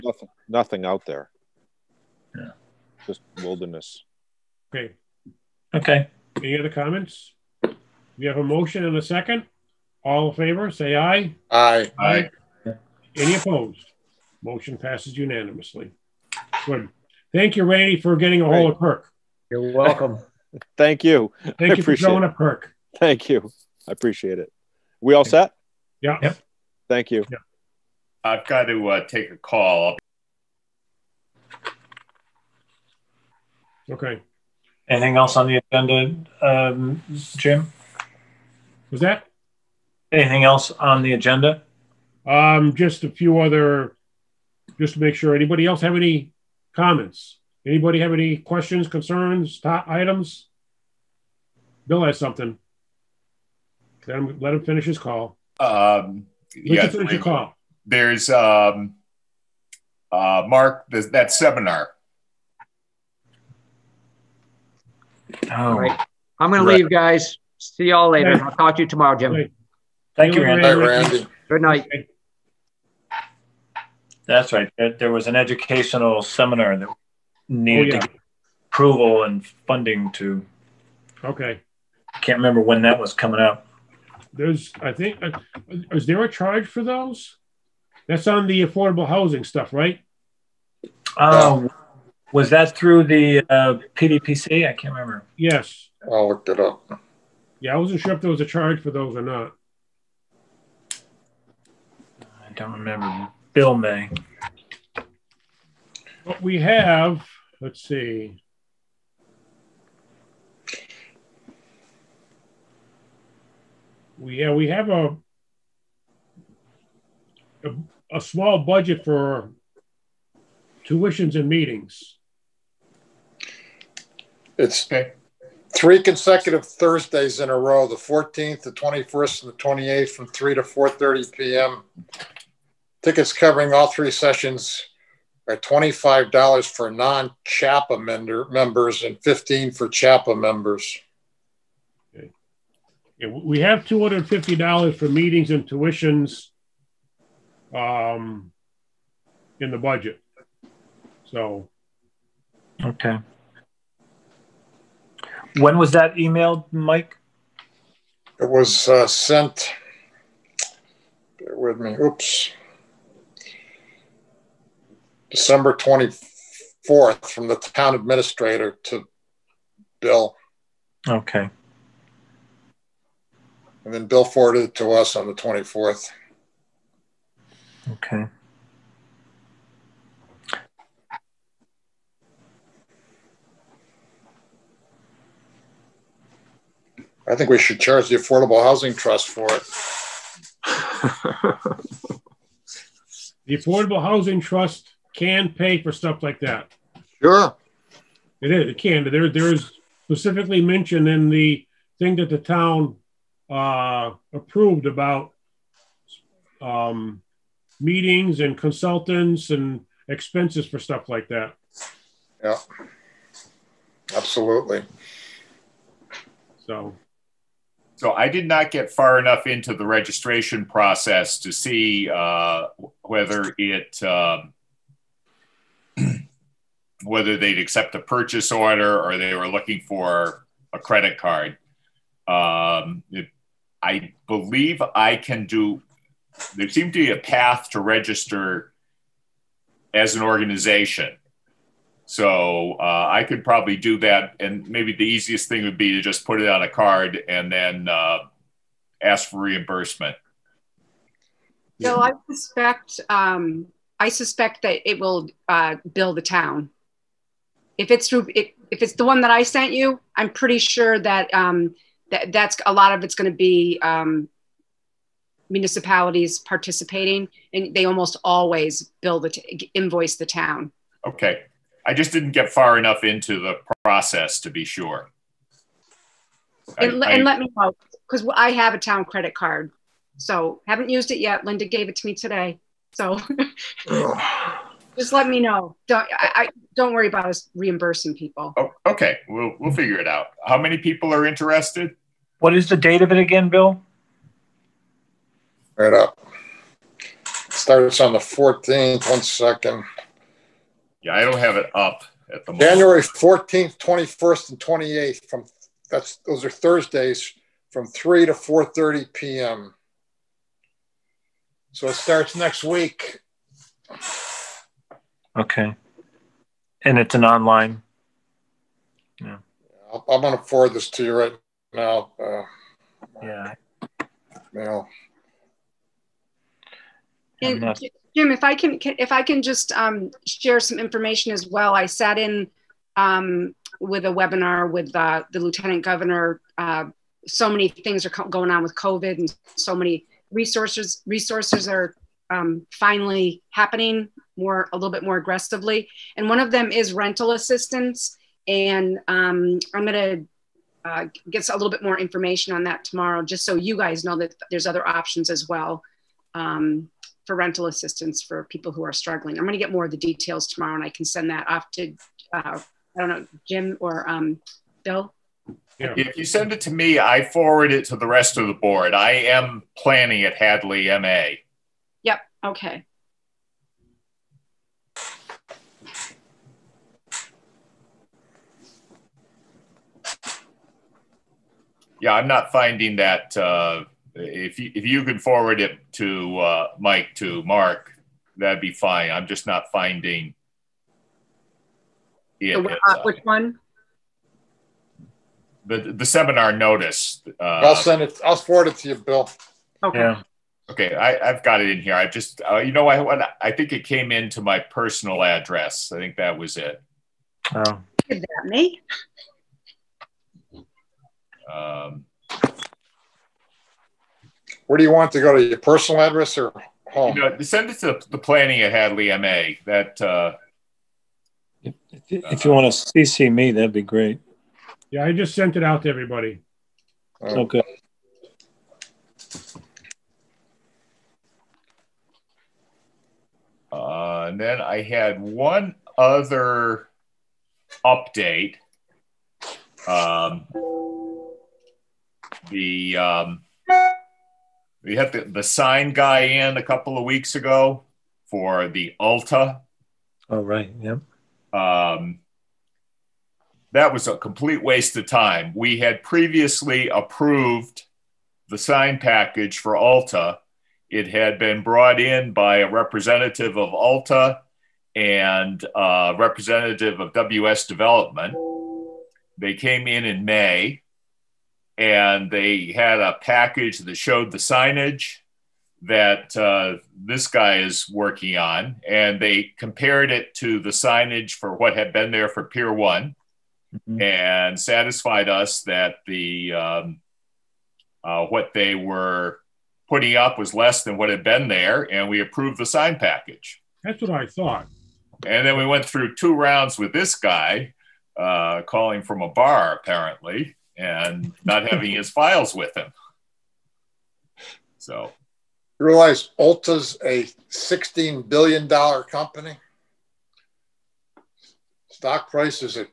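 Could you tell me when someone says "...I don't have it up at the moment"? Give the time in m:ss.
5:01.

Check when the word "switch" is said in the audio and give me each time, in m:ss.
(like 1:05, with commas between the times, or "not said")
not said.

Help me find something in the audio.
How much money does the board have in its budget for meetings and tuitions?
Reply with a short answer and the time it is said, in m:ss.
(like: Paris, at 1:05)
$250, at 2:23.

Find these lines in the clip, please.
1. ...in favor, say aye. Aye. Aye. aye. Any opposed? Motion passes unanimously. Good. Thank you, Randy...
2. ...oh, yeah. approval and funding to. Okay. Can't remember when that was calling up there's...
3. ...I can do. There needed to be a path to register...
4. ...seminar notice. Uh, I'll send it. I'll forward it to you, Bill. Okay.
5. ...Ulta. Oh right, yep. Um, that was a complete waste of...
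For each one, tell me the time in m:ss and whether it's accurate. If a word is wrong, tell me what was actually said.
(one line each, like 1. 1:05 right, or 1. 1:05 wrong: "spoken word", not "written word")
1. 0:10 right
2. 1:17 wrong: "coming", not "calling"
3. 3:54 wrong: "seemed", not "needed"
4. 6:36 right
5. 7:28 right.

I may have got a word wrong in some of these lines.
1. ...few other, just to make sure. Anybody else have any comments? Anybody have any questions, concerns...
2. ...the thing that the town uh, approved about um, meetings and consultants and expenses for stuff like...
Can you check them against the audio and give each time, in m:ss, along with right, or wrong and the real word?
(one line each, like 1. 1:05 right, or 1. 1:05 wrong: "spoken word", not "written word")
1. 0:43 right
2. 3:21 right.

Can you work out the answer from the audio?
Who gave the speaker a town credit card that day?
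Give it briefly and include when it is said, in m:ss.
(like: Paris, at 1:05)
Linda, at 4:41.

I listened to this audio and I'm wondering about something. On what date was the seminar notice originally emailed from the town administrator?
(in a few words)
December 24th.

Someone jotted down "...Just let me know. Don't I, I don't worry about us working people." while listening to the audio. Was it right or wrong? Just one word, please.
wrong.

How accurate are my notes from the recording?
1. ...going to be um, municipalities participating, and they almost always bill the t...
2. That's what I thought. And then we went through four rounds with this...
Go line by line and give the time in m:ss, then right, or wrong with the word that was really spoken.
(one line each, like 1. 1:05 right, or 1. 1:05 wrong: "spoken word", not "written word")
1. 4:23 right
2. 8:13 wrong: "two", not "four".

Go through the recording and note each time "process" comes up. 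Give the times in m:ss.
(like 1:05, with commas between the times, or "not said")
3:40, 4:33.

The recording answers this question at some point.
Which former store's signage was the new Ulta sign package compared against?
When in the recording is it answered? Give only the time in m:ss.
8:02.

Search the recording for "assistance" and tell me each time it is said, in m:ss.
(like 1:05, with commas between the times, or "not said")
5:47, 5:57.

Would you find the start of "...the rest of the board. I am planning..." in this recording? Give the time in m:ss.
6:07.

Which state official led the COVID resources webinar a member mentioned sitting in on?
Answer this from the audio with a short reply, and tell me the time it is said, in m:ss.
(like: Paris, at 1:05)
lieutenant governor, at 5:35.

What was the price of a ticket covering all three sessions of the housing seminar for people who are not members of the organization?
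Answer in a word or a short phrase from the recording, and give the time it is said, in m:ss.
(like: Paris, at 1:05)
$25, at 2:15.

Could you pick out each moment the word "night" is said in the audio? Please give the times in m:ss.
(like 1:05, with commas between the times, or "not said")
1:11.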